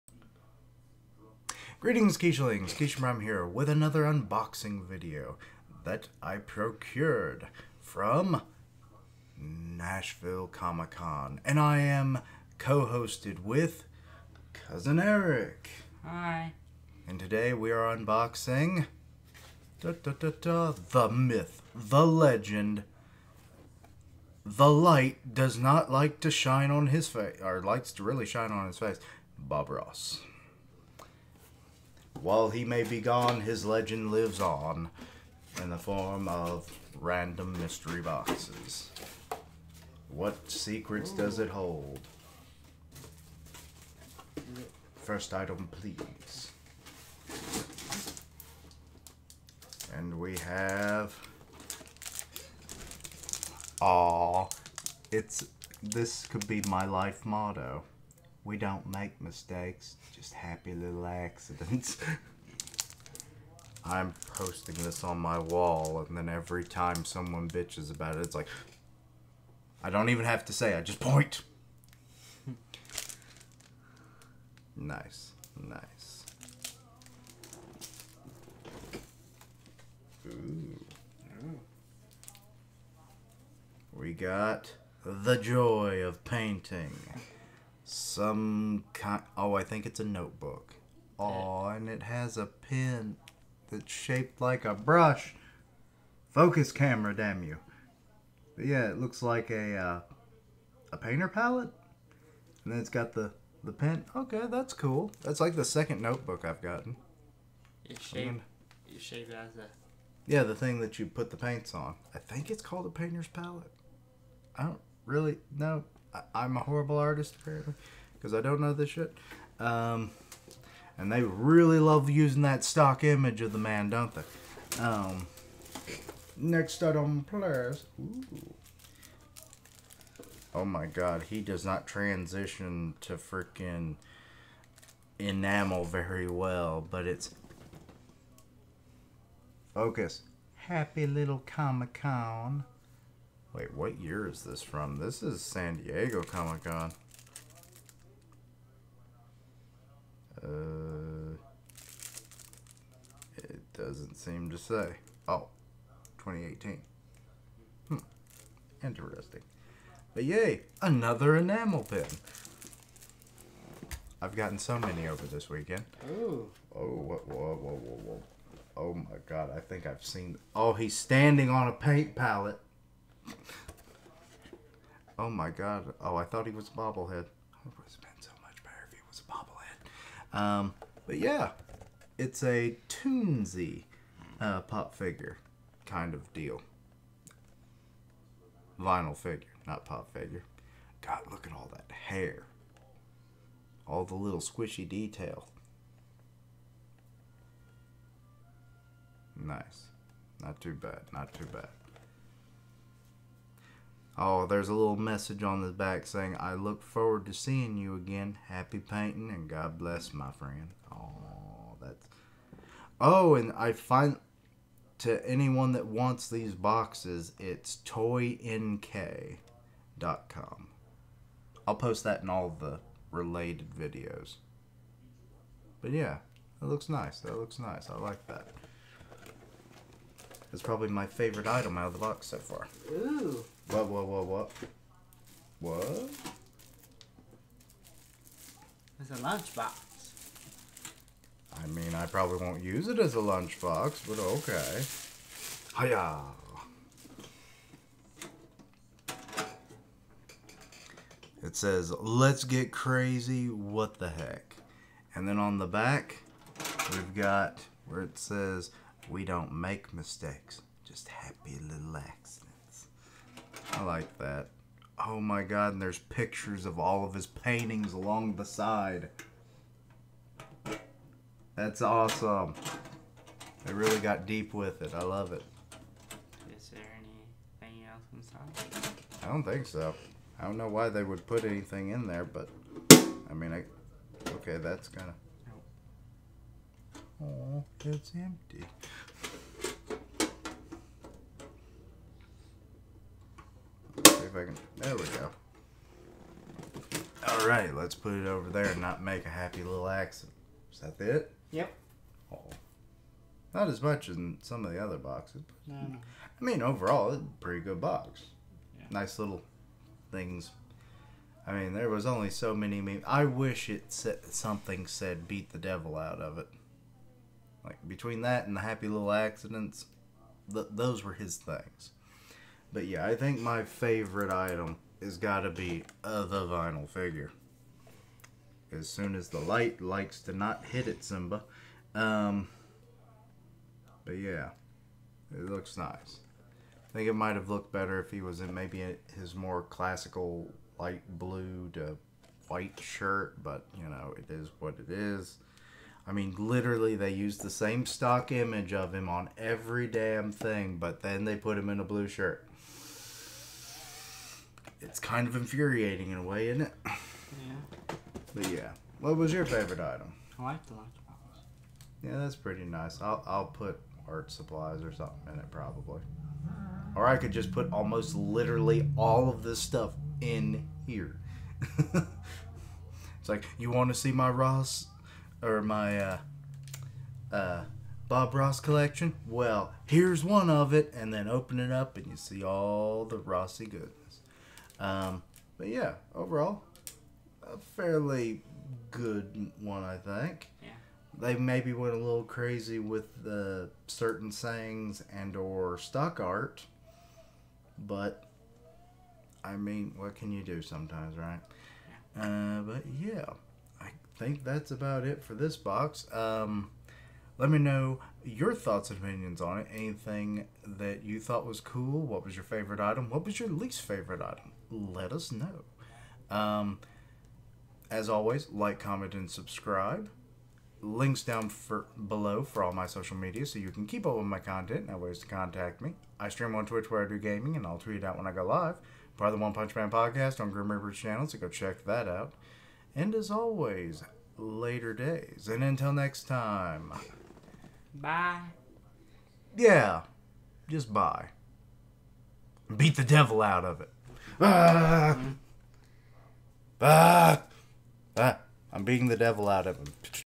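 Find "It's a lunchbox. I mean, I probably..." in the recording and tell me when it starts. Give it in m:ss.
3:58.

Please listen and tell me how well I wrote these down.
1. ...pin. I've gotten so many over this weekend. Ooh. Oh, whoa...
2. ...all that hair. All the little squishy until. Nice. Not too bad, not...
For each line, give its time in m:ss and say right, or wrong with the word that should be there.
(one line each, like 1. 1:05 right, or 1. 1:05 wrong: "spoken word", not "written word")
1. 2:41 right
2. 3:11 wrong: "detail", not "until".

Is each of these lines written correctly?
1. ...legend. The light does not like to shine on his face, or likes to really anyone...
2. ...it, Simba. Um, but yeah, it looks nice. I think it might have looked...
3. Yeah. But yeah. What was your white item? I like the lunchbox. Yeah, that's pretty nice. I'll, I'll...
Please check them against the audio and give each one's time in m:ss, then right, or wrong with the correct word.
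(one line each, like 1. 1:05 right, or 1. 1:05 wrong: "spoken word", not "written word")
1. 0:22 wrong: "shine", not "anyone"
2. 5:30 right
3. 5:56 wrong: "favorite", not "white".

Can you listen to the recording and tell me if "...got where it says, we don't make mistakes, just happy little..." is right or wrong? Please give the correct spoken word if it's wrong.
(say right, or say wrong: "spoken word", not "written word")
right.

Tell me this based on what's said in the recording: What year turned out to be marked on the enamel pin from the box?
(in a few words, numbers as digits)
2018.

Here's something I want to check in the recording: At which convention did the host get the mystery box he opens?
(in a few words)
Nashville Comic Con.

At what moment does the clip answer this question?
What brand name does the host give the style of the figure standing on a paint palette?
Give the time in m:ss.
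3:02.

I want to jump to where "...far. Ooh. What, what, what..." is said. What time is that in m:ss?
3:52.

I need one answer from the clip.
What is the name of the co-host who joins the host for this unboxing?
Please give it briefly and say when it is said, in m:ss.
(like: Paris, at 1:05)
Cousin Eric, at 0:14.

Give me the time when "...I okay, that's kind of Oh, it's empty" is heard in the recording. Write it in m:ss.
4:43.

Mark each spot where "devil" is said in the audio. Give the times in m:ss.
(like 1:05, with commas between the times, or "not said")
5:15, 7:23, 7:29.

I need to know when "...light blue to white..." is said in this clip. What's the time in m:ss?
5:40.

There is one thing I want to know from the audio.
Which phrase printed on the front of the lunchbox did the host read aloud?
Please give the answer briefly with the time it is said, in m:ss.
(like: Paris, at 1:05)
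Let's get crazy, what the heck, at 4:11.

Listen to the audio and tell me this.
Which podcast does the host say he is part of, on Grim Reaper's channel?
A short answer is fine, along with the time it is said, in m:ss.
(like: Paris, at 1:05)
One Punch Man podcast, at 7:09.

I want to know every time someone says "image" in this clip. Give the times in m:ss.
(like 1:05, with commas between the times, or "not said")
2:03, 5:48.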